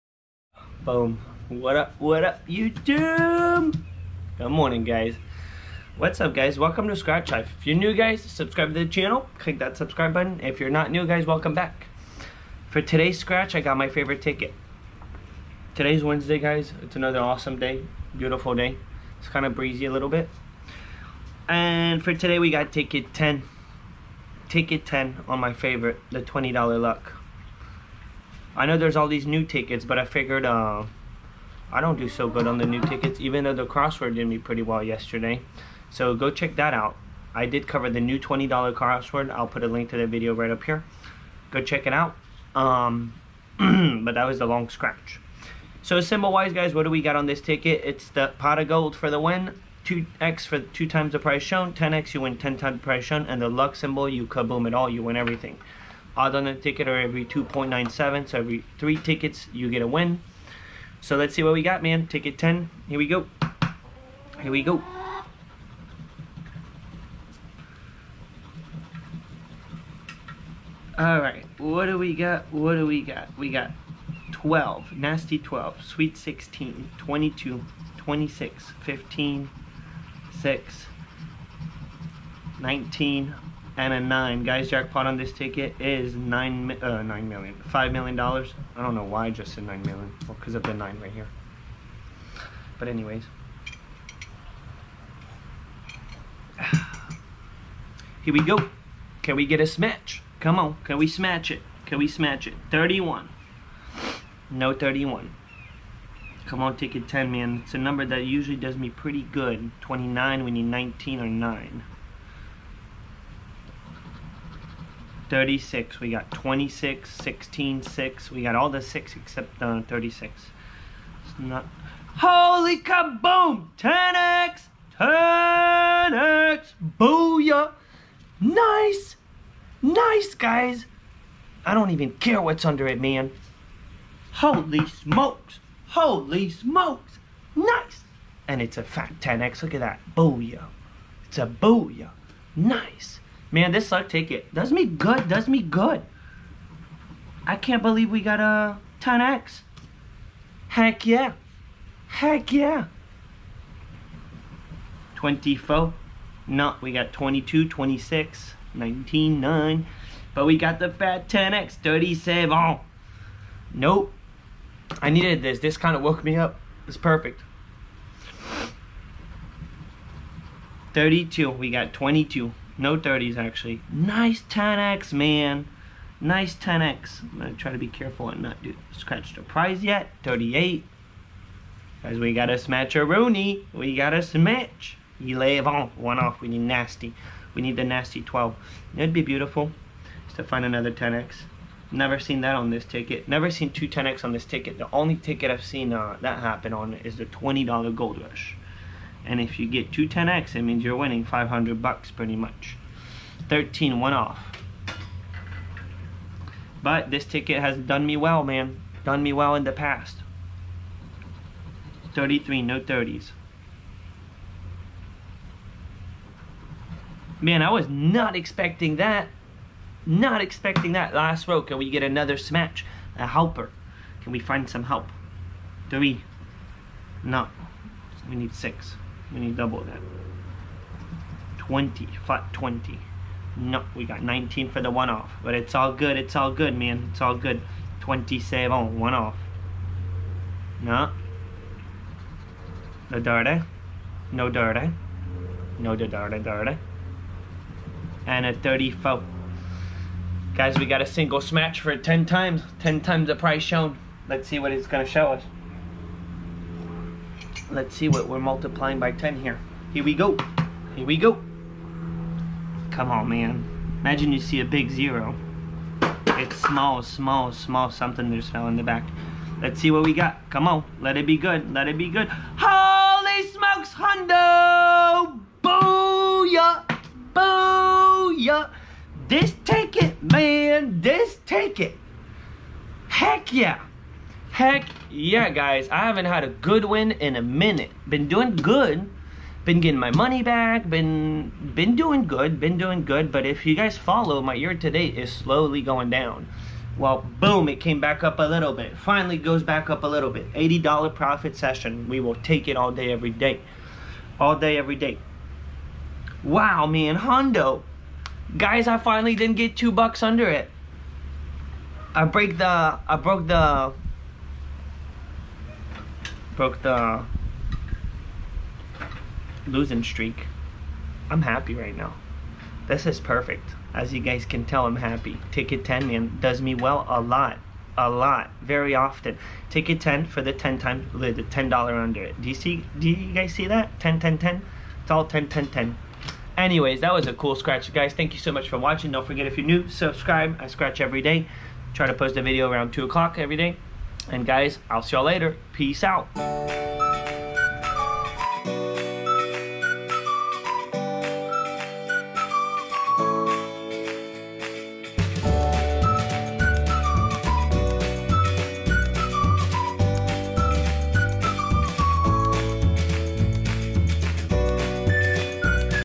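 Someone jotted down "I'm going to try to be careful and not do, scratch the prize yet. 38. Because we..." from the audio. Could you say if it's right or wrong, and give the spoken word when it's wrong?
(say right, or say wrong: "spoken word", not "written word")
right.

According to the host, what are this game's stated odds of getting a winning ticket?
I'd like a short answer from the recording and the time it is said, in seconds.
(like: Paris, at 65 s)
2.97, at 57 s.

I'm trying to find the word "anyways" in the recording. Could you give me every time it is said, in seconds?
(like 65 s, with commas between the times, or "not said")
92 s, 336 s.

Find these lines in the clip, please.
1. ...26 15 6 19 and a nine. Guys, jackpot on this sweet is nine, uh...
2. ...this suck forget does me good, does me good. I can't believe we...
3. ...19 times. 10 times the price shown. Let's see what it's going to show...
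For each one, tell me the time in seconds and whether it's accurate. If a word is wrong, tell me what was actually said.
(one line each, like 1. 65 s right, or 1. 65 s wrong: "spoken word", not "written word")
1. 77 s wrong: "ticket", not "sweet"
2. 143 s wrong: "ticket", not "forget"
3. 251 s wrong: "10", not "19".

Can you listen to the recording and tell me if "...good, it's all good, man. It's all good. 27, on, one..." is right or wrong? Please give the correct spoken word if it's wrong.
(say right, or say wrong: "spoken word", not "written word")
right.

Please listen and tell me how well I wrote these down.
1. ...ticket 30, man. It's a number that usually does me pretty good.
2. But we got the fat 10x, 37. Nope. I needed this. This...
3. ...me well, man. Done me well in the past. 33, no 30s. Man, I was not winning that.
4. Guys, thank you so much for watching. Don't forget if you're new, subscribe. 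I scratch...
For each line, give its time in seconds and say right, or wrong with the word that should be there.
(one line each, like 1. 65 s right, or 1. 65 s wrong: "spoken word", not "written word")
1. 106 s wrong: "10", not "30"
2. 160 s right
3. 208 s wrong: "expecting", not "winning"
4. 337 s right.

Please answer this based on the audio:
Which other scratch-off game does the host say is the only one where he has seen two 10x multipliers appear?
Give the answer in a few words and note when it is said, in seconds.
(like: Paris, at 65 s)
$20 Gold Rush, at 197 s.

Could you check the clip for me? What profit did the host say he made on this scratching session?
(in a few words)
$80.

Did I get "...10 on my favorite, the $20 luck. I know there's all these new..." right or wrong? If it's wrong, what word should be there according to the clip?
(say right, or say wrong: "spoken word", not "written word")
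right.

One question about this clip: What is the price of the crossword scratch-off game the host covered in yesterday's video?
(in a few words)
$20.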